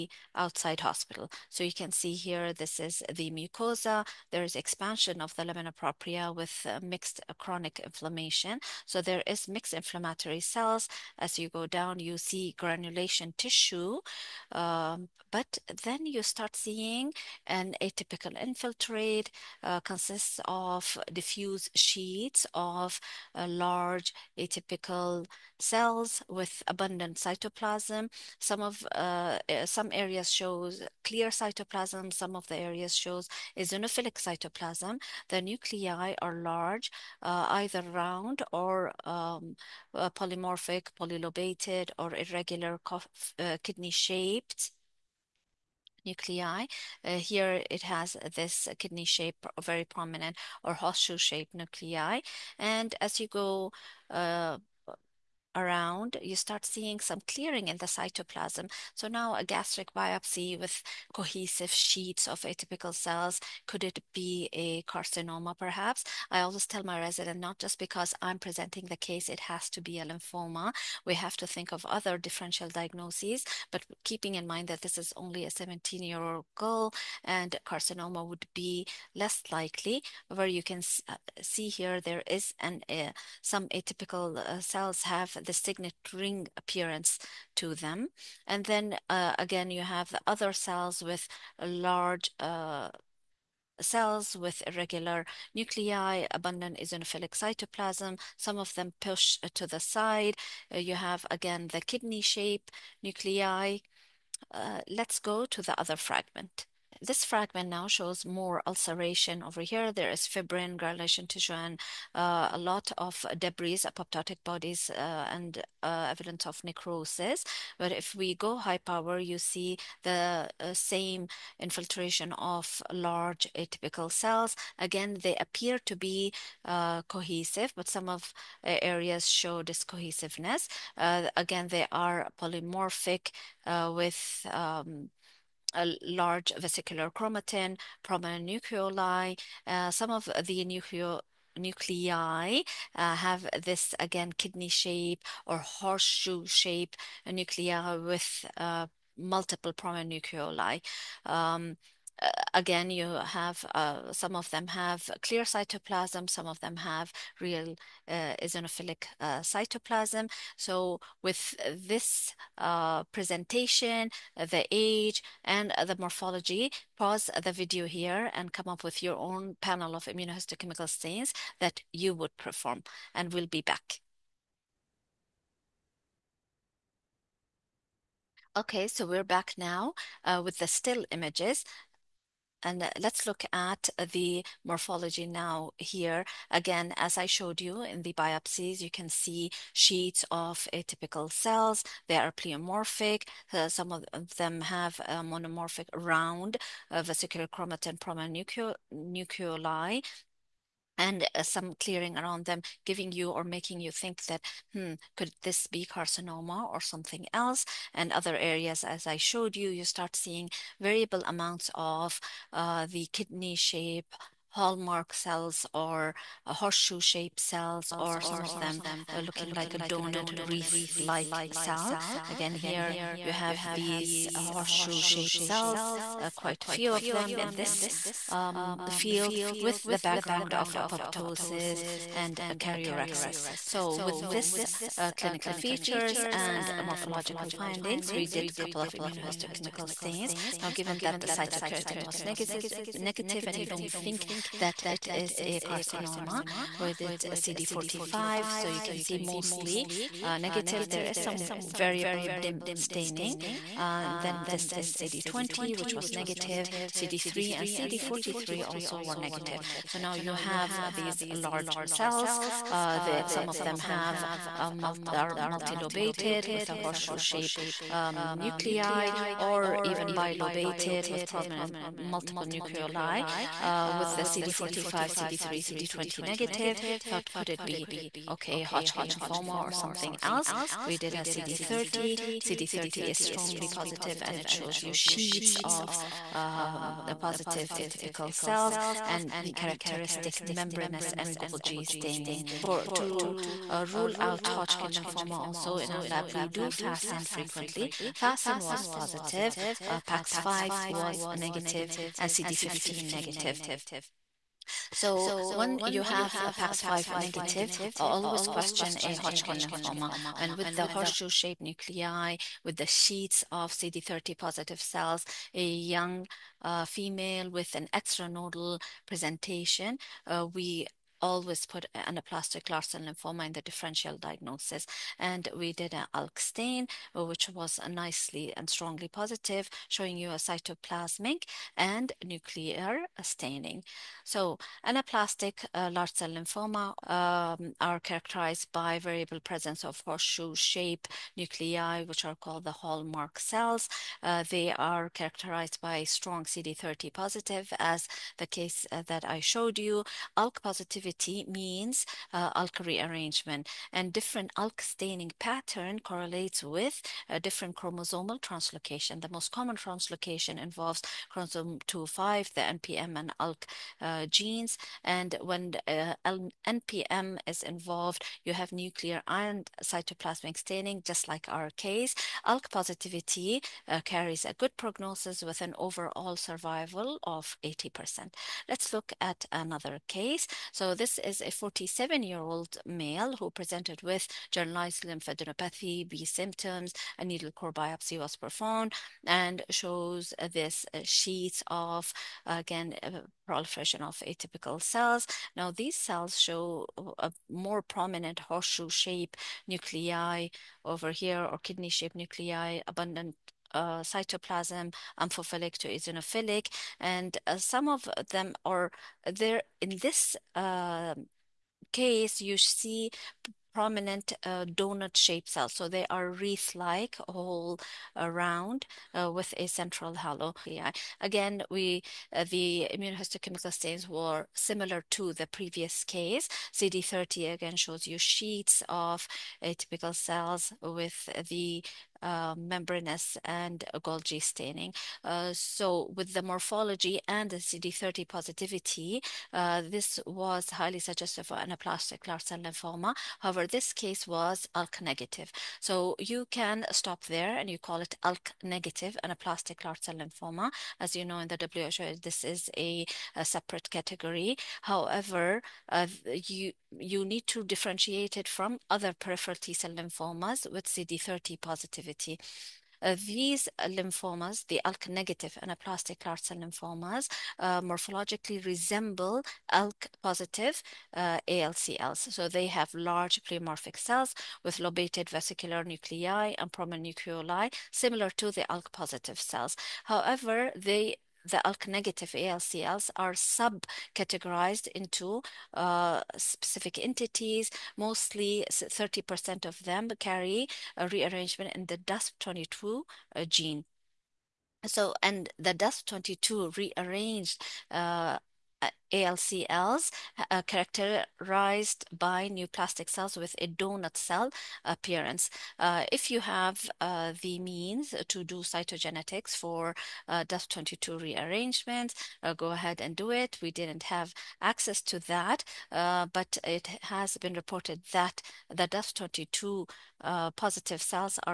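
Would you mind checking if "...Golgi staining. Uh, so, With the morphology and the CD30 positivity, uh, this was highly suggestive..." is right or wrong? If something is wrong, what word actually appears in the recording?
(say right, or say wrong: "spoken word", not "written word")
right.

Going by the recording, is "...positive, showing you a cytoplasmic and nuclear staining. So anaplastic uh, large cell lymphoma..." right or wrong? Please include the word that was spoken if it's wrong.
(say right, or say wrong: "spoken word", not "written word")
right.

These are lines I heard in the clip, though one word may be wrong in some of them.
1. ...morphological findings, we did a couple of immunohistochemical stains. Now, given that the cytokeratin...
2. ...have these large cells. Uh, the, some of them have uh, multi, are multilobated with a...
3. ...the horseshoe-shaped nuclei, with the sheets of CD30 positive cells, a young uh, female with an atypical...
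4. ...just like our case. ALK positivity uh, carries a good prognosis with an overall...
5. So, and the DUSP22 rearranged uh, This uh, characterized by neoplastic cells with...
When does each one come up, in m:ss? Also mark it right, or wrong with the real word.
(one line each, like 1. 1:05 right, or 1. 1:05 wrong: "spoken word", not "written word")
1. 3:56 right
2. 4:20 right
3. 5:10 wrong: "extranodal", not "atypical"
4. 6:11 right
5. 8:14 wrong: "ALCLs", not "This".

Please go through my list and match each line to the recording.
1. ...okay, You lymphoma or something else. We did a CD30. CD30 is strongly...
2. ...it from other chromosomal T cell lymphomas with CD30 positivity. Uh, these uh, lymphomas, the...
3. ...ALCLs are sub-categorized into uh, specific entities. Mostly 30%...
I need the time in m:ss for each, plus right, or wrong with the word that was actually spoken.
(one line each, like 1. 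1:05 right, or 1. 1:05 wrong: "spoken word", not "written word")
1. 4:38 wrong: "Hodgkin", not "You"
2. 7:38 wrong: "peripheral", not "chromosomal"
3. 8:02 right.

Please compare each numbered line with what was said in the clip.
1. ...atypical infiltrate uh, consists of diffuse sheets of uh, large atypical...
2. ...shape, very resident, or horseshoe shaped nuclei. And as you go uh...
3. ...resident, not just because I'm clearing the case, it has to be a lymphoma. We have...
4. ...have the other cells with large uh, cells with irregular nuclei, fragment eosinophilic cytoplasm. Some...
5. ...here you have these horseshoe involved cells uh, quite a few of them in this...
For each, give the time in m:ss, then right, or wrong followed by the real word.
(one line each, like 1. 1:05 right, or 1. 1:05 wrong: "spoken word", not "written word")
1. 0:17 right
2. 0:49 wrong: "prominent", not "resident"
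3. 1:06 wrong: "presenting", not "clearing"
4. 1:29 wrong: "abundant", not "fragment"
5. 3:42 wrong: "shaped", not "involved".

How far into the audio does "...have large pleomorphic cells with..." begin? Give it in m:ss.
7:52.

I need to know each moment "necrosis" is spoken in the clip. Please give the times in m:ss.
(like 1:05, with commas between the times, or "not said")
1:56.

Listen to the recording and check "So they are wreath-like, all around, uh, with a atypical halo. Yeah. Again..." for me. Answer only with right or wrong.
wrong.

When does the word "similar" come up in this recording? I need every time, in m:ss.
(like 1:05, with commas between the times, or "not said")
7:04, 7:57.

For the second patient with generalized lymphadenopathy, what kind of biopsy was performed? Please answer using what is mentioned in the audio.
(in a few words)
Needle core biopsy.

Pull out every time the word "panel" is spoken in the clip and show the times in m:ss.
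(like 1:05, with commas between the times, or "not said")
2:49.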